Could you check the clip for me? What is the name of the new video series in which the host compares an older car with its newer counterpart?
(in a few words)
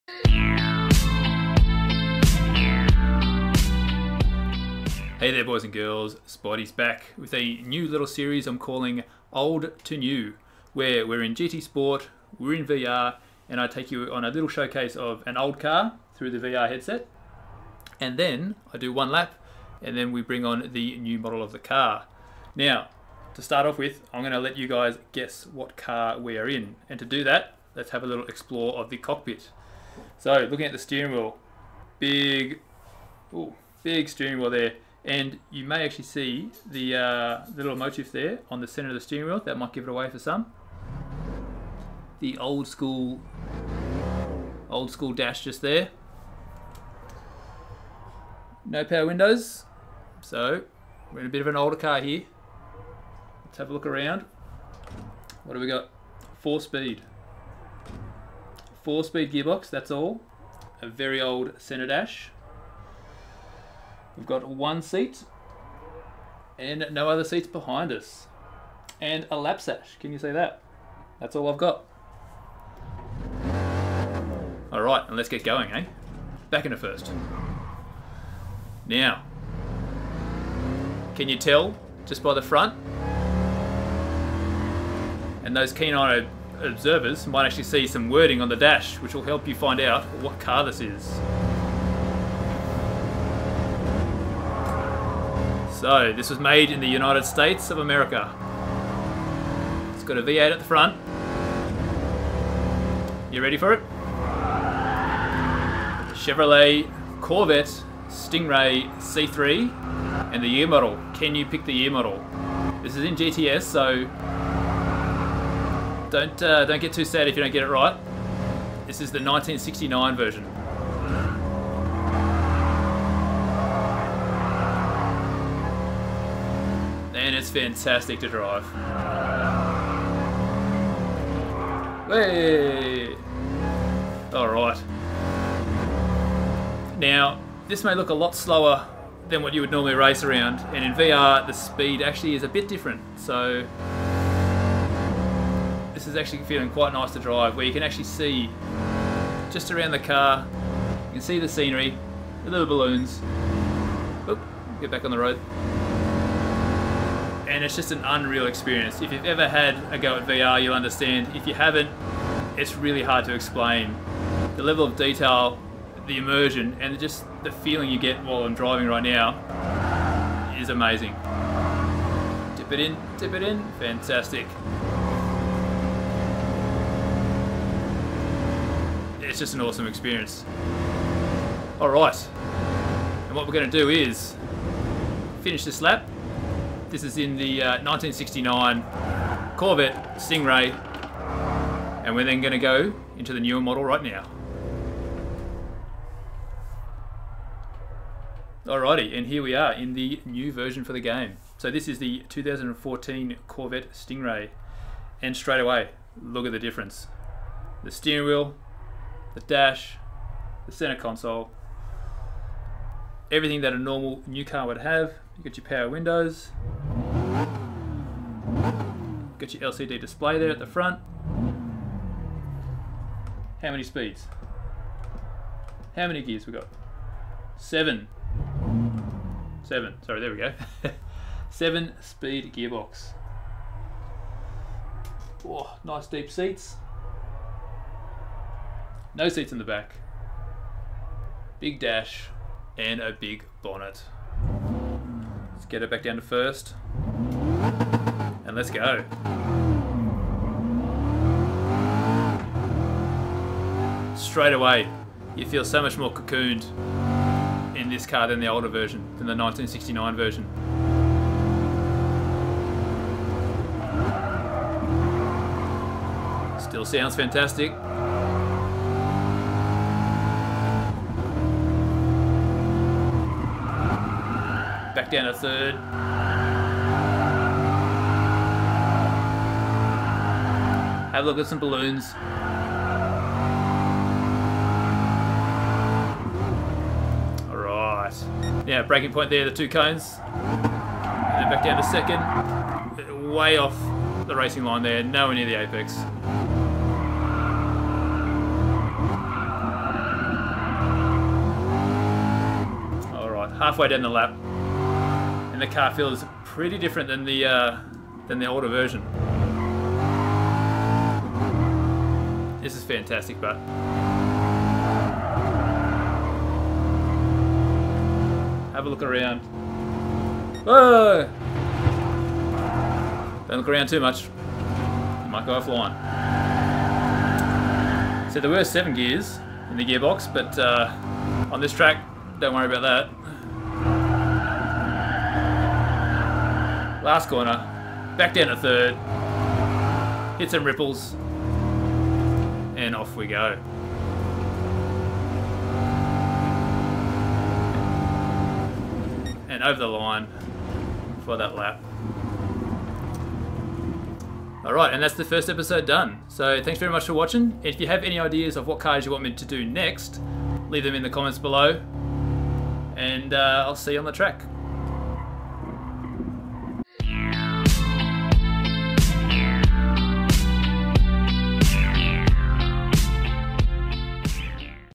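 Old to New.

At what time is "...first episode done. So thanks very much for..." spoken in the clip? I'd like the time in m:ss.
5:55.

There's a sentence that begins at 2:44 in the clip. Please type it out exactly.
The level of detail, the immersion, and just the feeling you get while I'm driving right now is amazing.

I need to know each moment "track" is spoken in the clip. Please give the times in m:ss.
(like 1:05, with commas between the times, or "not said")
5:31, 6:04.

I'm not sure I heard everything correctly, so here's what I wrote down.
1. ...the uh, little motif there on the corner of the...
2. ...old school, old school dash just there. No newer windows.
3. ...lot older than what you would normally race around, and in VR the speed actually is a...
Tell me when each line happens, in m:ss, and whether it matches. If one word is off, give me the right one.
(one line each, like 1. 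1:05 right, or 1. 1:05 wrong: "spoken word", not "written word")
1. 0:36 wrong: "center", not "corner"
2. 0:42 wrong: "power", not "newer"
3. 2:18 wrong: "slower", not "older".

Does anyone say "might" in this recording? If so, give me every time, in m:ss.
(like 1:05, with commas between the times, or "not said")
0:39, 1:27, 5:25.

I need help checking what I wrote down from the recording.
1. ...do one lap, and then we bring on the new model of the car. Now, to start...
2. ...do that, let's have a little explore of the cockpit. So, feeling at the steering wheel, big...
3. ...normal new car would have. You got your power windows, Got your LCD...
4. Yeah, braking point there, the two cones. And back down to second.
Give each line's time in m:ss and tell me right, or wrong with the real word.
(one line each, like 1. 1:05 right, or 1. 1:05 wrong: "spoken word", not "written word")
1. 0:18 right
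2. 0:27 wrong: "looking", not "feeling"
3. 3:33 right
4. 4:48 right.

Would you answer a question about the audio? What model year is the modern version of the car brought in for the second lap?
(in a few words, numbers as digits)
2014.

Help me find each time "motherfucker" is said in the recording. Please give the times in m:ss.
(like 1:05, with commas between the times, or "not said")
not said.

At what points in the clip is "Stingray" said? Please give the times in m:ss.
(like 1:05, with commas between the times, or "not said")
1:48, 3:10, 3:23.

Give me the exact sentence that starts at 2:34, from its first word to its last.
Oop, get back on the road and it's just an unreal experience.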